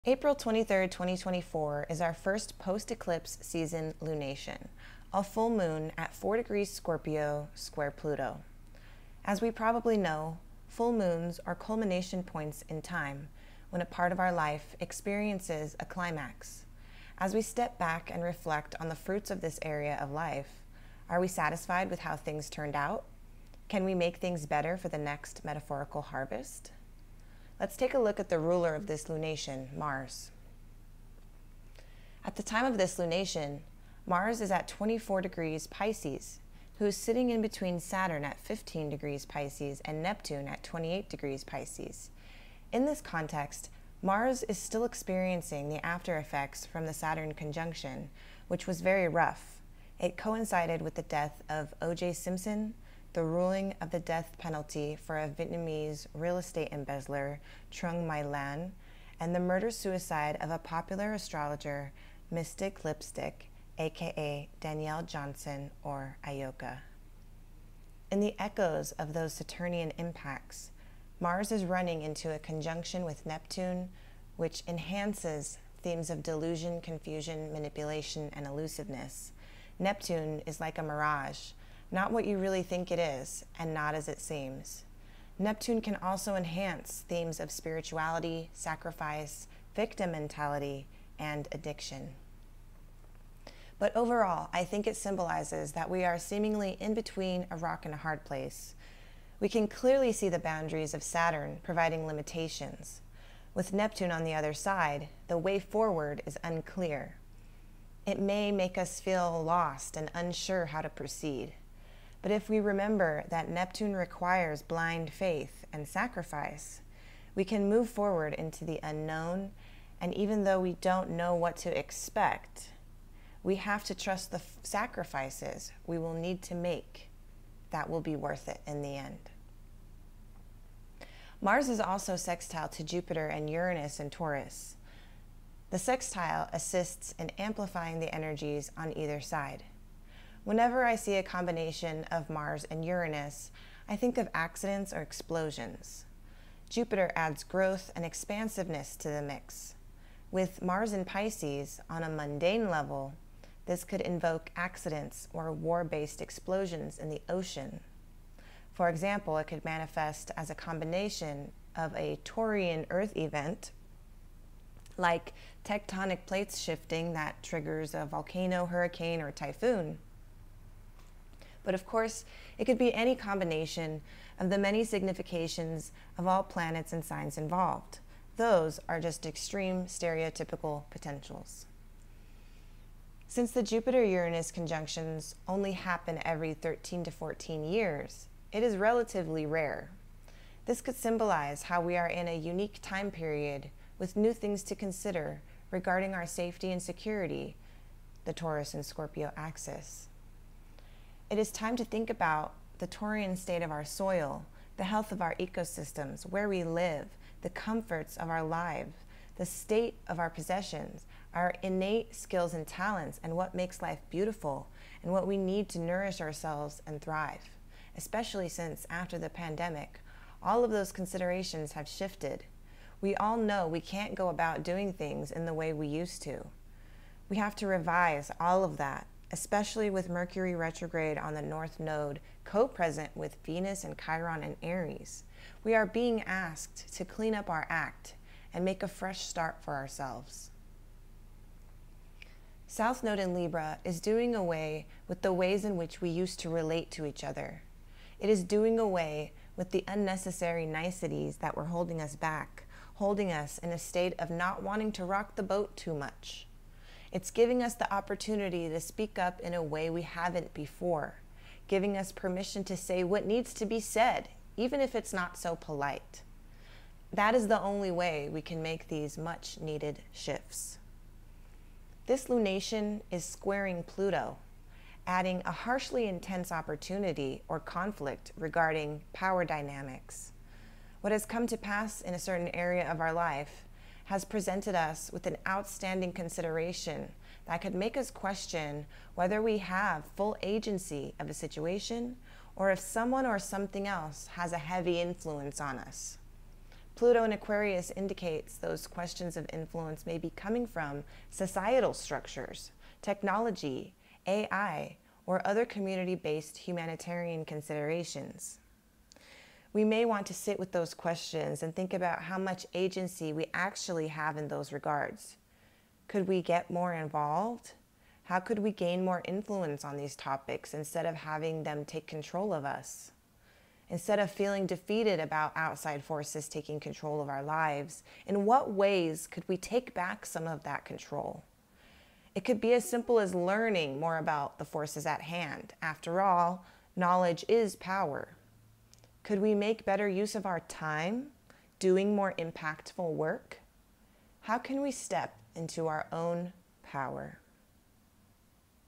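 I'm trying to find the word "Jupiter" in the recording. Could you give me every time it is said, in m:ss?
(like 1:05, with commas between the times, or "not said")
2:12, 2:26, 3:03.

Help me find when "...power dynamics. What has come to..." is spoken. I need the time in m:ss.
4:39.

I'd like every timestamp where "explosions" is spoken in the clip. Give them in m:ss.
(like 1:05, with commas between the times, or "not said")
2:25, 2:36.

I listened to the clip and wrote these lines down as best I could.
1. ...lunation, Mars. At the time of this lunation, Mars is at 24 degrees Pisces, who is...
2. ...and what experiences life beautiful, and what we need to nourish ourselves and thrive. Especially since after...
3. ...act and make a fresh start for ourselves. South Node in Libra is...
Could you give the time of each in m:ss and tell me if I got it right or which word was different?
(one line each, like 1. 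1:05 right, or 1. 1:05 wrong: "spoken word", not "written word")
1. 0:29 right
2. 3:33 wrong: "makes", not "experiences"
3. 3:57 right.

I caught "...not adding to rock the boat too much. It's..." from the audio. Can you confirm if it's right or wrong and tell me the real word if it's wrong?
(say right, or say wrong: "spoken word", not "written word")
wrong: "wanting", not "adding".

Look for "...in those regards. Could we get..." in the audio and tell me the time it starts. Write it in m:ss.
5:14.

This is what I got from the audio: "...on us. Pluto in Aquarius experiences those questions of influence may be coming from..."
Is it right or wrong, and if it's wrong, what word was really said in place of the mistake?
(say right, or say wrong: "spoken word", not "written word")
wrong: "indicates", not "experiences".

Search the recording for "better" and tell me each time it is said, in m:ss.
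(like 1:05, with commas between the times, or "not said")
0:24, 5:39.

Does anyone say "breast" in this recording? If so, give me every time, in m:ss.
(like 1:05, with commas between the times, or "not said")
not said.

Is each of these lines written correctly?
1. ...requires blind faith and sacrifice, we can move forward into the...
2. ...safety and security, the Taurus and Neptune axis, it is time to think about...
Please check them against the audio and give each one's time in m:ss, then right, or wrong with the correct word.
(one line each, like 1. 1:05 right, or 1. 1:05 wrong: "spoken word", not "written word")
1. 1:53 right
2. 3:16 wrong: "Scorpio", not "Neptune".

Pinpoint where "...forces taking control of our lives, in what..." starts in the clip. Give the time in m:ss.
5:26.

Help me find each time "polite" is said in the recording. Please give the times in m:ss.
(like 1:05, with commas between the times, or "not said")
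4:25.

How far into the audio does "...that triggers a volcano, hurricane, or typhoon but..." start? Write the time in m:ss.
2:47.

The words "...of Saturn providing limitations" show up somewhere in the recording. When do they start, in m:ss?
1:40.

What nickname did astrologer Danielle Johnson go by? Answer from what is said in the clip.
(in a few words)
Mystic Lipstick.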